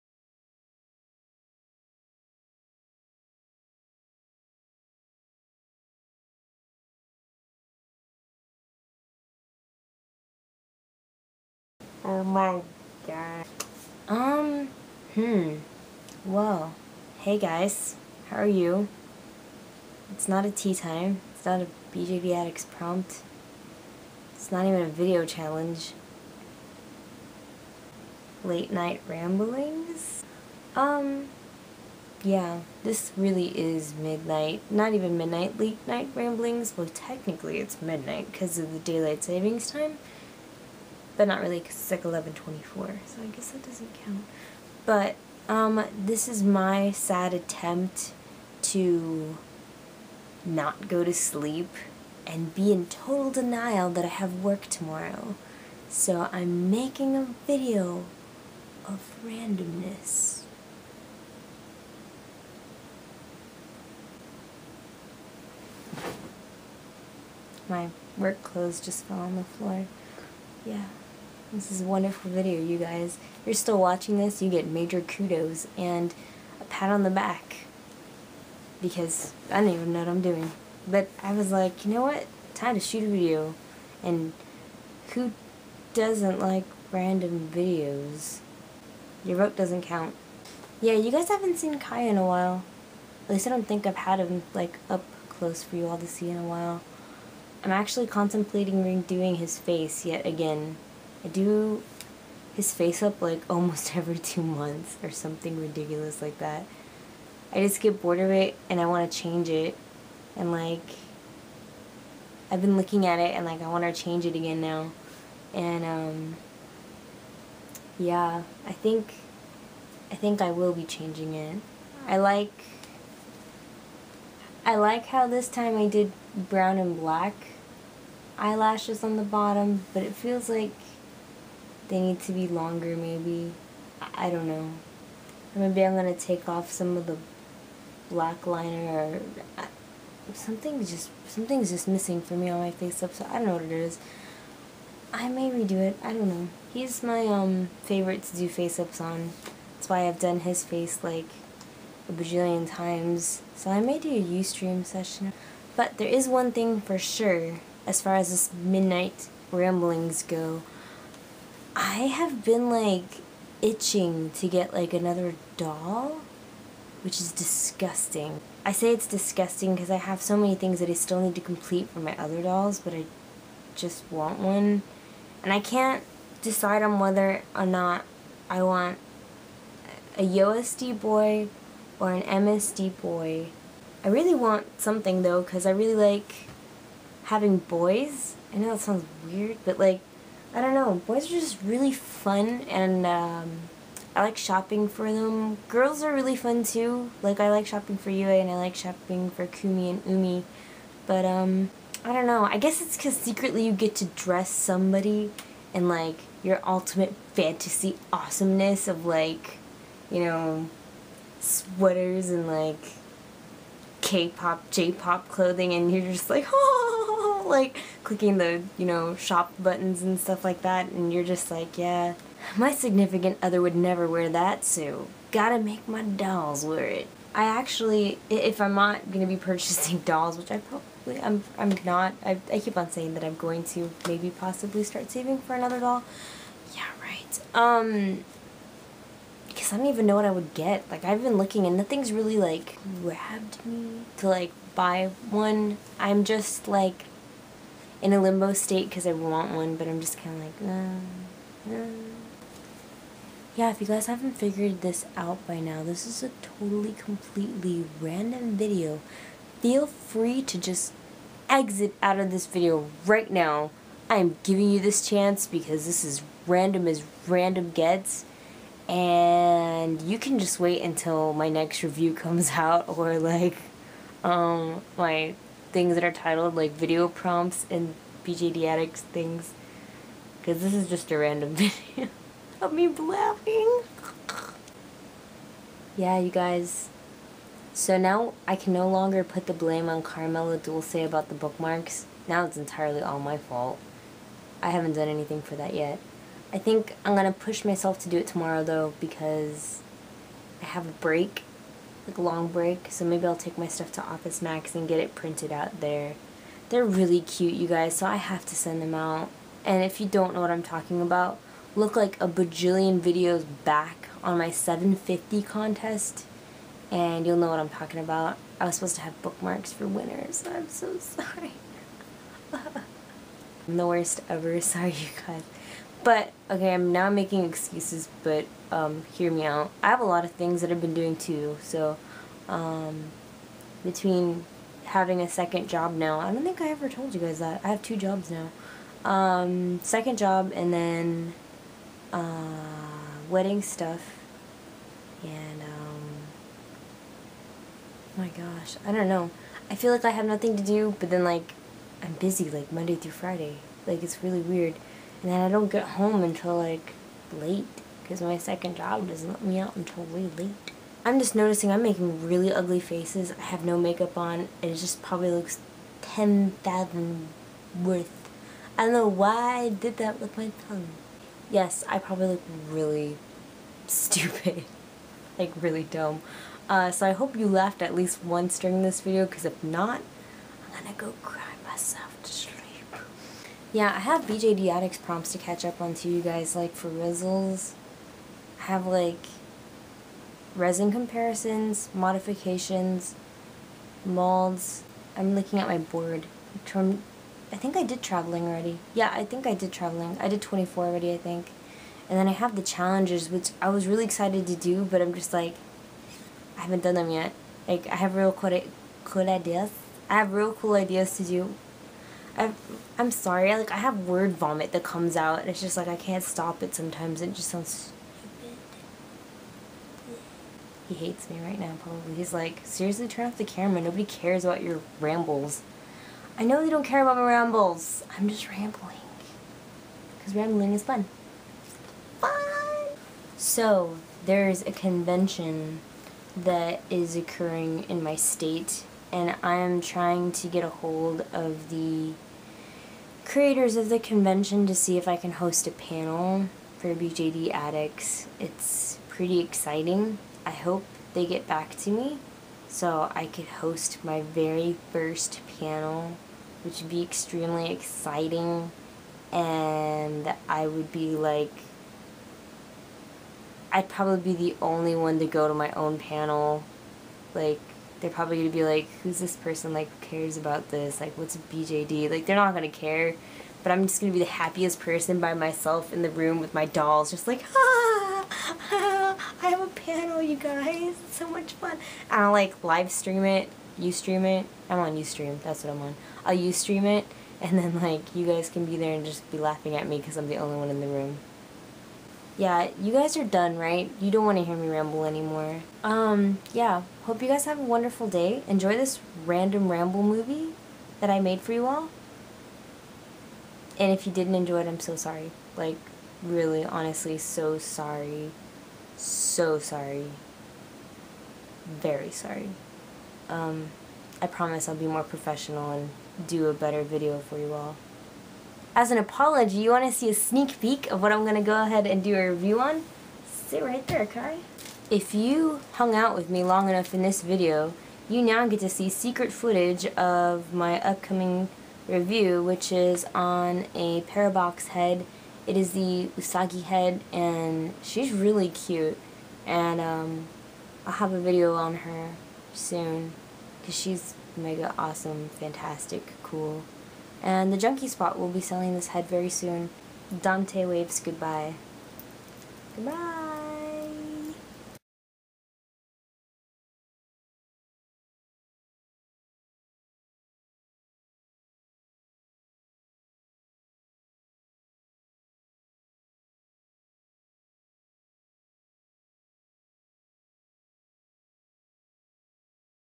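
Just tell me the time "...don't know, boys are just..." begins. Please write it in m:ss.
3:10.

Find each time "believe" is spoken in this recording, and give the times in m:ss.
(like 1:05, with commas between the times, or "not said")
not said.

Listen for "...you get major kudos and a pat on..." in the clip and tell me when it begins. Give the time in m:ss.
1:14.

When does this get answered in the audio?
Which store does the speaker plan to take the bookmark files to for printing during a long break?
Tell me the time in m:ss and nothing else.
5:04.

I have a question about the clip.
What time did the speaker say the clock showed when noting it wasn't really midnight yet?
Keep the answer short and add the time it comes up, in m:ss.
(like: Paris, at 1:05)
11:24, at 0:42.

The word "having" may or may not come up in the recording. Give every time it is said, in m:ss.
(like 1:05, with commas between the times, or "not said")
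3:07, 5:34.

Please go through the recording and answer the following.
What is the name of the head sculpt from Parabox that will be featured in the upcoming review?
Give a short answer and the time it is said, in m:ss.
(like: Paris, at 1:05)
Usagi, at 8:56.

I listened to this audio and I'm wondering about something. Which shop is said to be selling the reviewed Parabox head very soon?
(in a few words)
The Junky Spot.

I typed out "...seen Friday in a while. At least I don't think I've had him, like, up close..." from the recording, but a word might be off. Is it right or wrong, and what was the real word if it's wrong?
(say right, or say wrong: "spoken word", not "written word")
wrong: "Kai", not "Friday".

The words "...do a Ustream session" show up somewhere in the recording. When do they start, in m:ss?
2:33.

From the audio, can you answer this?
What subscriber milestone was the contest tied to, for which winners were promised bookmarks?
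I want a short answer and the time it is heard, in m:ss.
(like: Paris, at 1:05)
750, at 5:14.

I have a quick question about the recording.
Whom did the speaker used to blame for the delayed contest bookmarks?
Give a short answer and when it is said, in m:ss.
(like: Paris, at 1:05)
Carmela Dulce, at 4:50.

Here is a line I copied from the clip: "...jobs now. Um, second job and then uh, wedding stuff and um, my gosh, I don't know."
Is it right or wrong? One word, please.
right.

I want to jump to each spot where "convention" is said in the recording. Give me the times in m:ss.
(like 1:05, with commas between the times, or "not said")
7:14, 7:23.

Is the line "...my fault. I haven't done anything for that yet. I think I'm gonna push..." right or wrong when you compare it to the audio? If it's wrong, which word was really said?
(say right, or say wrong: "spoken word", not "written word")
right.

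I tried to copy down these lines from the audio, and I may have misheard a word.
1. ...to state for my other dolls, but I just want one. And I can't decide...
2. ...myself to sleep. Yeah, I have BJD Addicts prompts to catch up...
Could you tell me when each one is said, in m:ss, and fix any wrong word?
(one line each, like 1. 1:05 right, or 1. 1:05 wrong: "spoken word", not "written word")
1. 2:51 wrong: "complete", not "state"
2. 6:21 right.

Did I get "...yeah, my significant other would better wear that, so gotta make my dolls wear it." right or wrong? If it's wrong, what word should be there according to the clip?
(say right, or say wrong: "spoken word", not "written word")
wrong: "never", not "better".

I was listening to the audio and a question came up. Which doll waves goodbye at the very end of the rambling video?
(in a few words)
Dante.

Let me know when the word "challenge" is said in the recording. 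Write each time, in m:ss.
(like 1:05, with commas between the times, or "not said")
0:25, 6:42.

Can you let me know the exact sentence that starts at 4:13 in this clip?
Yeah, if you guys haven't figured this out by now, this is a totally, completely random video.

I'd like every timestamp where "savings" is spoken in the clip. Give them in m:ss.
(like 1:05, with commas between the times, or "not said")
0:39, 3:55.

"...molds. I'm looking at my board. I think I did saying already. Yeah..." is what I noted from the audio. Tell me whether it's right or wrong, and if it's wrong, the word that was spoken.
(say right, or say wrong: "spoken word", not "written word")
wrong: "traveling", not "saying".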